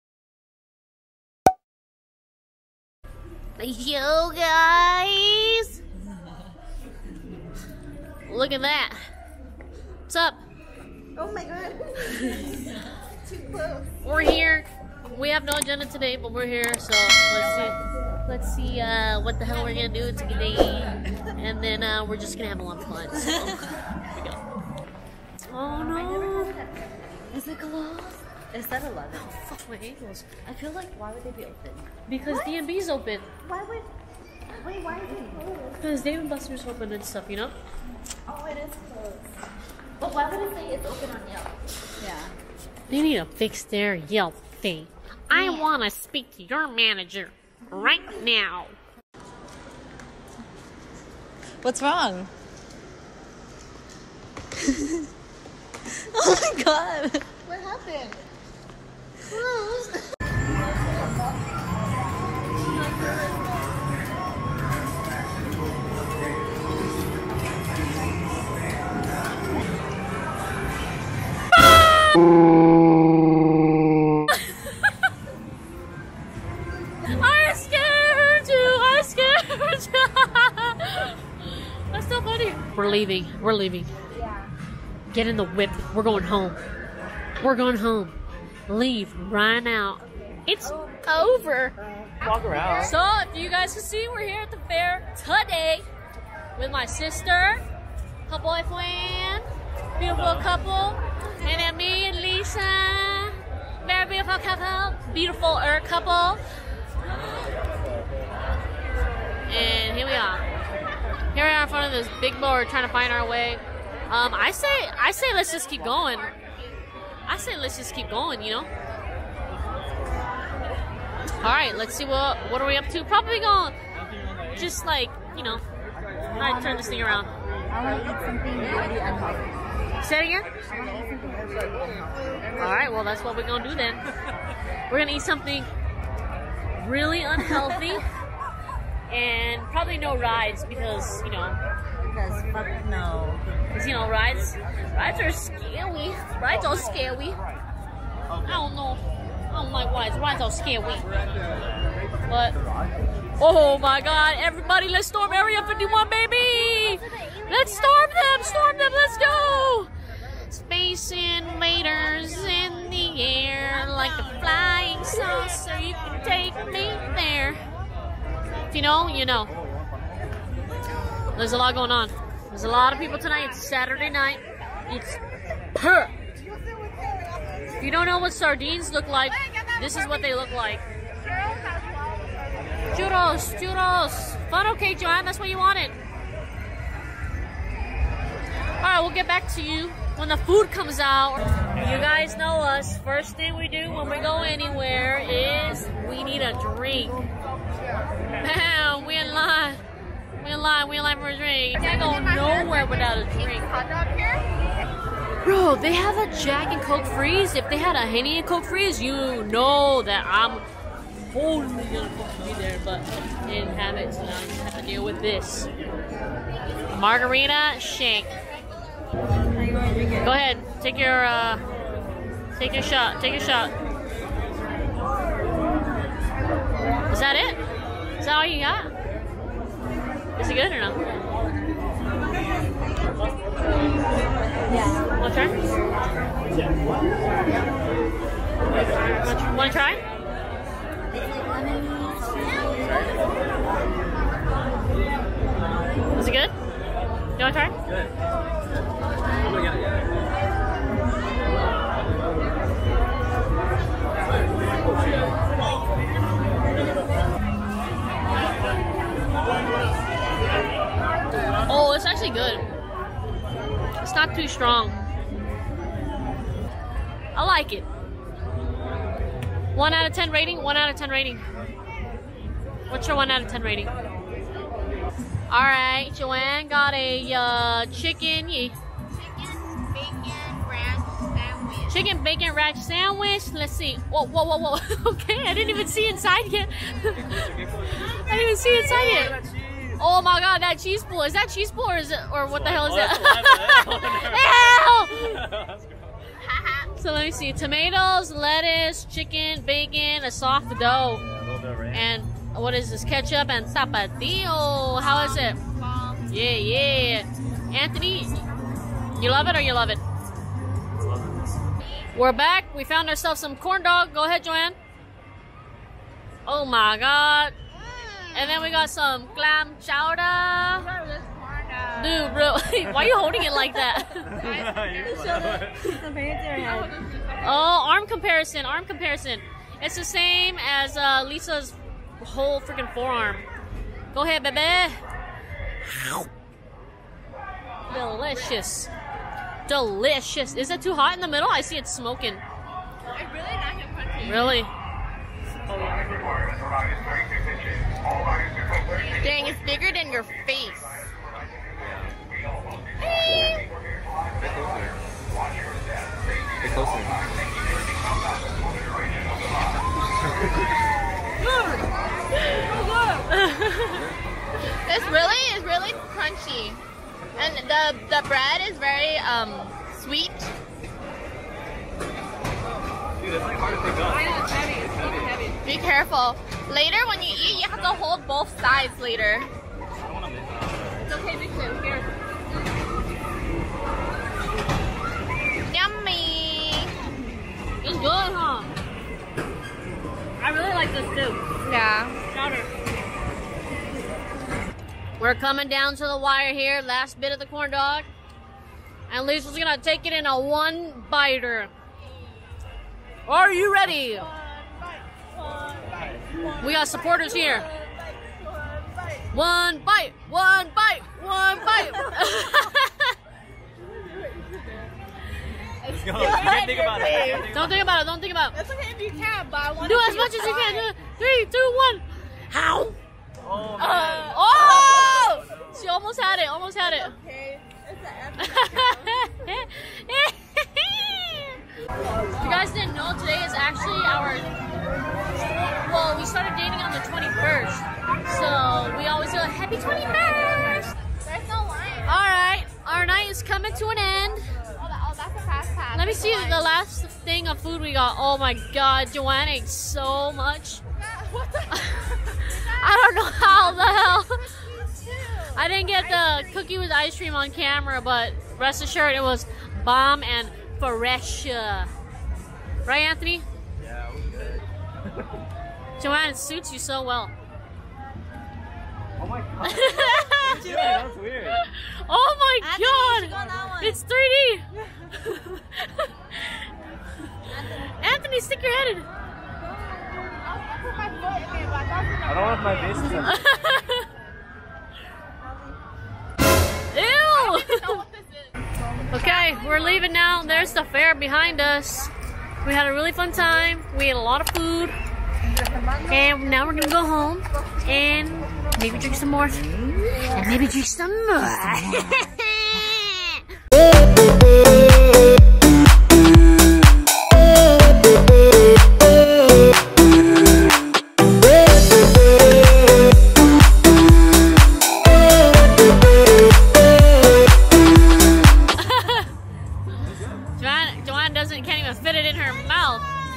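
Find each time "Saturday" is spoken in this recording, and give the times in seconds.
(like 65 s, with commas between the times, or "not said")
173 s.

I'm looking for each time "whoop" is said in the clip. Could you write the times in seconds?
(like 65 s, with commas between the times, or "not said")
not said.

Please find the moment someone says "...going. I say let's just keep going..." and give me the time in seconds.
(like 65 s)
115 s.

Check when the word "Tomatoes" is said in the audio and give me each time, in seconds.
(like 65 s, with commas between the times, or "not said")
297 s.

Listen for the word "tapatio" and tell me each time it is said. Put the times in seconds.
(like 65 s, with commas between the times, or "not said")
303 s.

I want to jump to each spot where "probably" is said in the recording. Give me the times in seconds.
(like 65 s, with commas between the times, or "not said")
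123 s, 139 s.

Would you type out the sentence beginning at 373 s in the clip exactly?
Dude, that's like hard to pick up.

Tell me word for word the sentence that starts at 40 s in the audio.
But why would it say it's open on Yelp?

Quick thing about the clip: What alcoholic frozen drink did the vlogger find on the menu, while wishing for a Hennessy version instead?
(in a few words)
Jack and Coke freeze.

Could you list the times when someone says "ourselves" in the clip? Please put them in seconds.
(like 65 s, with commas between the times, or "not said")
313 s.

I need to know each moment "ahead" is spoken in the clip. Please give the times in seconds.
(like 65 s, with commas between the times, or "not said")
220 s, 314 s, 334 s.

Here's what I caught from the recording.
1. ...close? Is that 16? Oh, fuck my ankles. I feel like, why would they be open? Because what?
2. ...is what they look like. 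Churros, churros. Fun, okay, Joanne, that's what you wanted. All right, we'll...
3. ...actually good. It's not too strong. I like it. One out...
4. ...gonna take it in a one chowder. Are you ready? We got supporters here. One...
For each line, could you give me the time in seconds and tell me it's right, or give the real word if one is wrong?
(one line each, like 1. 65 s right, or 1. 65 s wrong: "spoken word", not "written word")
1. 27 s wrong: "11", not "16"
2. 179 s right
3. 262 s right
4. 399 s wrong: "biter", not "chowder".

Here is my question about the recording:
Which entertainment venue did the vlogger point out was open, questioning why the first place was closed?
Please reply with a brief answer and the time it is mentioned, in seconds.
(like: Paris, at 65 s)
Dave and Buster's, at 36 s.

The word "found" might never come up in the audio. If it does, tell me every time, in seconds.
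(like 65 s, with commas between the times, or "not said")
312 s.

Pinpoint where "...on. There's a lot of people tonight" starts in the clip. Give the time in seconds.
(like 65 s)
171 s.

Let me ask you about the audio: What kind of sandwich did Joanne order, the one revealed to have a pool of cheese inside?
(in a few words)
Chicken bacon ranch.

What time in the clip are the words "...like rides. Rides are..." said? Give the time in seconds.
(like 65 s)
149 s.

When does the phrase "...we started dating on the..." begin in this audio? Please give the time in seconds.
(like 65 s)
436 s.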